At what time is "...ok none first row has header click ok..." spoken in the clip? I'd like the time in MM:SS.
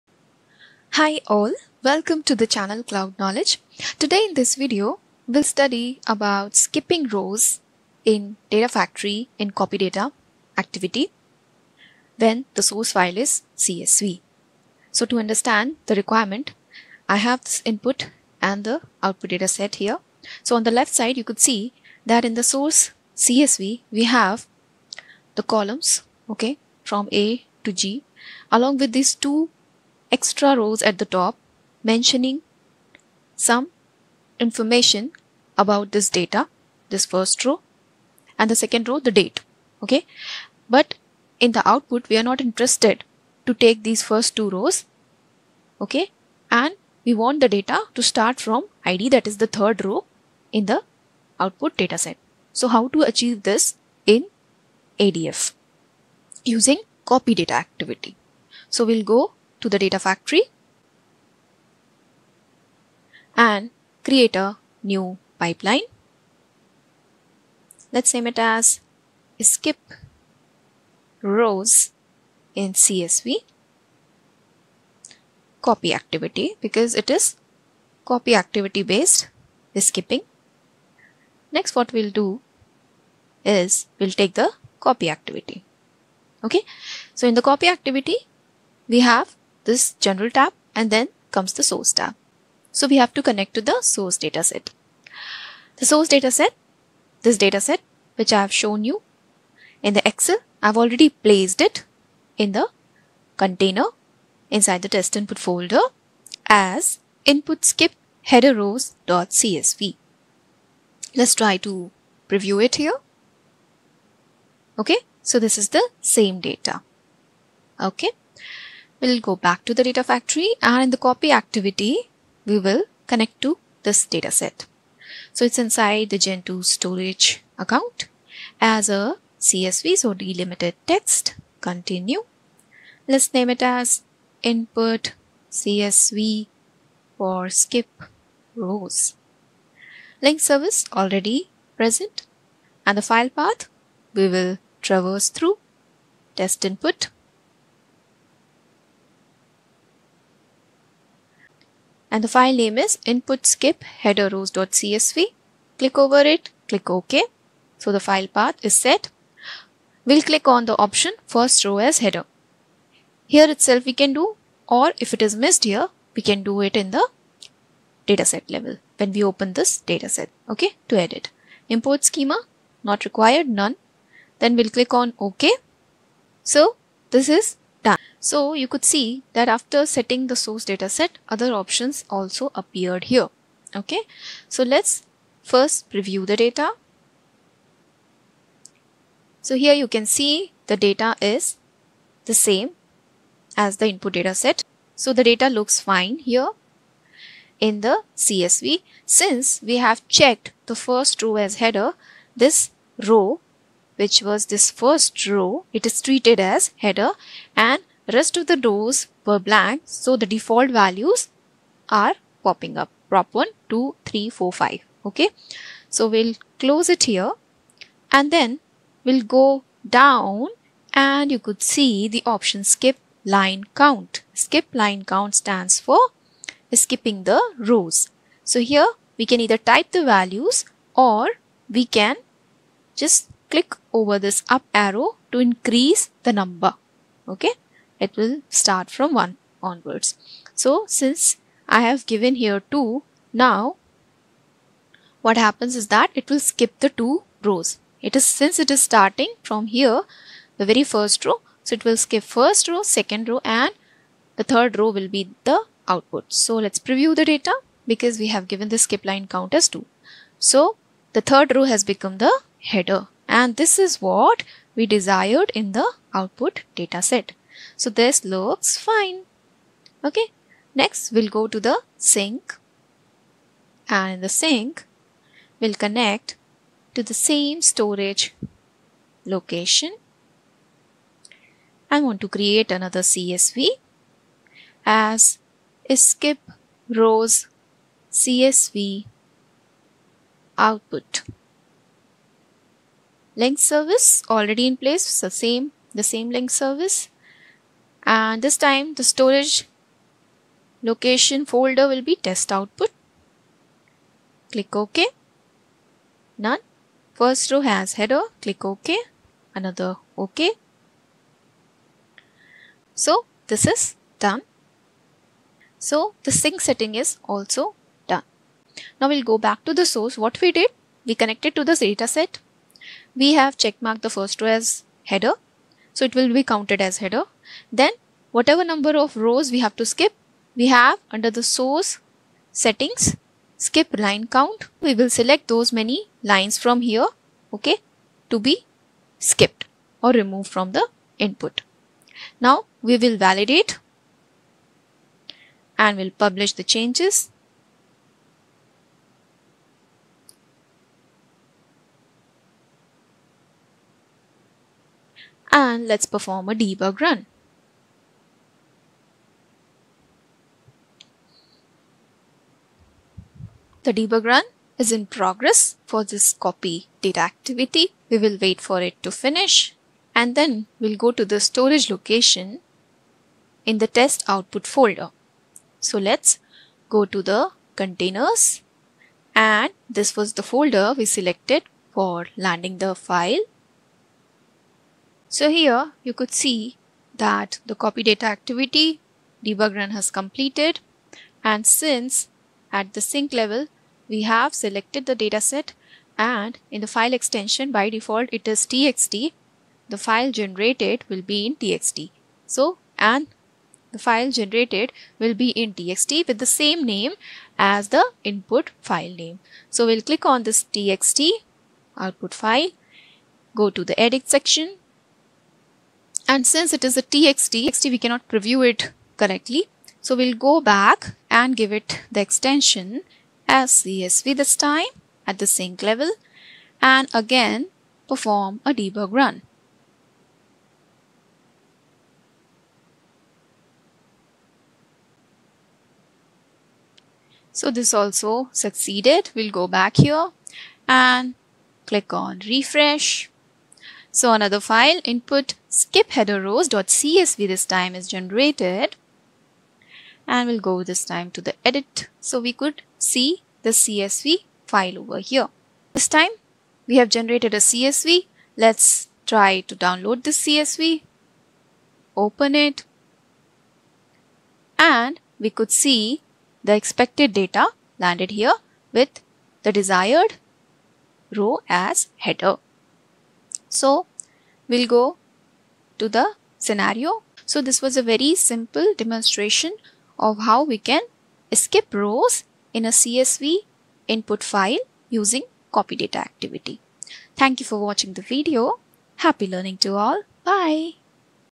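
05:04.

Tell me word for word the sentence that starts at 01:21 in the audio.
Next what we'll do is we'll take the copy activity.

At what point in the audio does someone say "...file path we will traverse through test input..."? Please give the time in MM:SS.
02:23.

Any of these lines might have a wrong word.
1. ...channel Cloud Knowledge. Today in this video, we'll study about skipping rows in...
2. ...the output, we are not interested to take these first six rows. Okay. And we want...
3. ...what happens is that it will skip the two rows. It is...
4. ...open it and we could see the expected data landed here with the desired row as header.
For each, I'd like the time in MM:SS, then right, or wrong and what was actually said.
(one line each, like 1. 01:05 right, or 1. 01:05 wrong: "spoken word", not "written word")
1. 00:02 right
2. 00:41 wrong: "two", not "six"
3. 04:05 right
4. 07:42 right.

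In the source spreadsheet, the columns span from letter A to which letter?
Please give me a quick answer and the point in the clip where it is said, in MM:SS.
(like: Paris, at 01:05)
G, at 00:27.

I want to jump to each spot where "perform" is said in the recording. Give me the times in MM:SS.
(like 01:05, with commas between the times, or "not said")
05:56, 07:08.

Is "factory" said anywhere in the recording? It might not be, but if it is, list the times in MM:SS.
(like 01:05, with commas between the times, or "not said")
00:08, 00:59, 02:00.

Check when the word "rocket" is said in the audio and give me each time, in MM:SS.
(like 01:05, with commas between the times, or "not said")
not said.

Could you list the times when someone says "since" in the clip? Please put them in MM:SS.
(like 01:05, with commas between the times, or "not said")
03:19, 04:00, 04:08, 06:31, 06:56.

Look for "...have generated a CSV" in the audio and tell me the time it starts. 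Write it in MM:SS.
07:36.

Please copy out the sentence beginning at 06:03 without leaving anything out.
The debug run is in progress for this copy data activity.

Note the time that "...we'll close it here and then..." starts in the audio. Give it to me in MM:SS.
03:36.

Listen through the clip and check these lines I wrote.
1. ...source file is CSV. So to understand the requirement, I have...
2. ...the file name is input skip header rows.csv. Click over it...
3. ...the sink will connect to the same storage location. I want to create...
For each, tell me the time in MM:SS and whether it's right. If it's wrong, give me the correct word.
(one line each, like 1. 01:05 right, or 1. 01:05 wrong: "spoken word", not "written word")
1. 00:12 right
2. 02:32 right
3. 04:34 right.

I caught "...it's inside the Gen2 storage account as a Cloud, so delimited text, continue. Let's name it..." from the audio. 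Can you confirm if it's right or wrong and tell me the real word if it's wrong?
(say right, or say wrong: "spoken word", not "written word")
wrong: "CSV", not "Cloud".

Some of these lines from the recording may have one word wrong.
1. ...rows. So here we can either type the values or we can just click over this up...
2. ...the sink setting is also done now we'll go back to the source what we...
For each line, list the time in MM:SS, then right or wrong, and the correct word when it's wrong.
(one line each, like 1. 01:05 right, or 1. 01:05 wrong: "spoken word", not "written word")
1. 03:47 right
2. 05:16 right.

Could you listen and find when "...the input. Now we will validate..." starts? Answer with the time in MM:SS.
05:40.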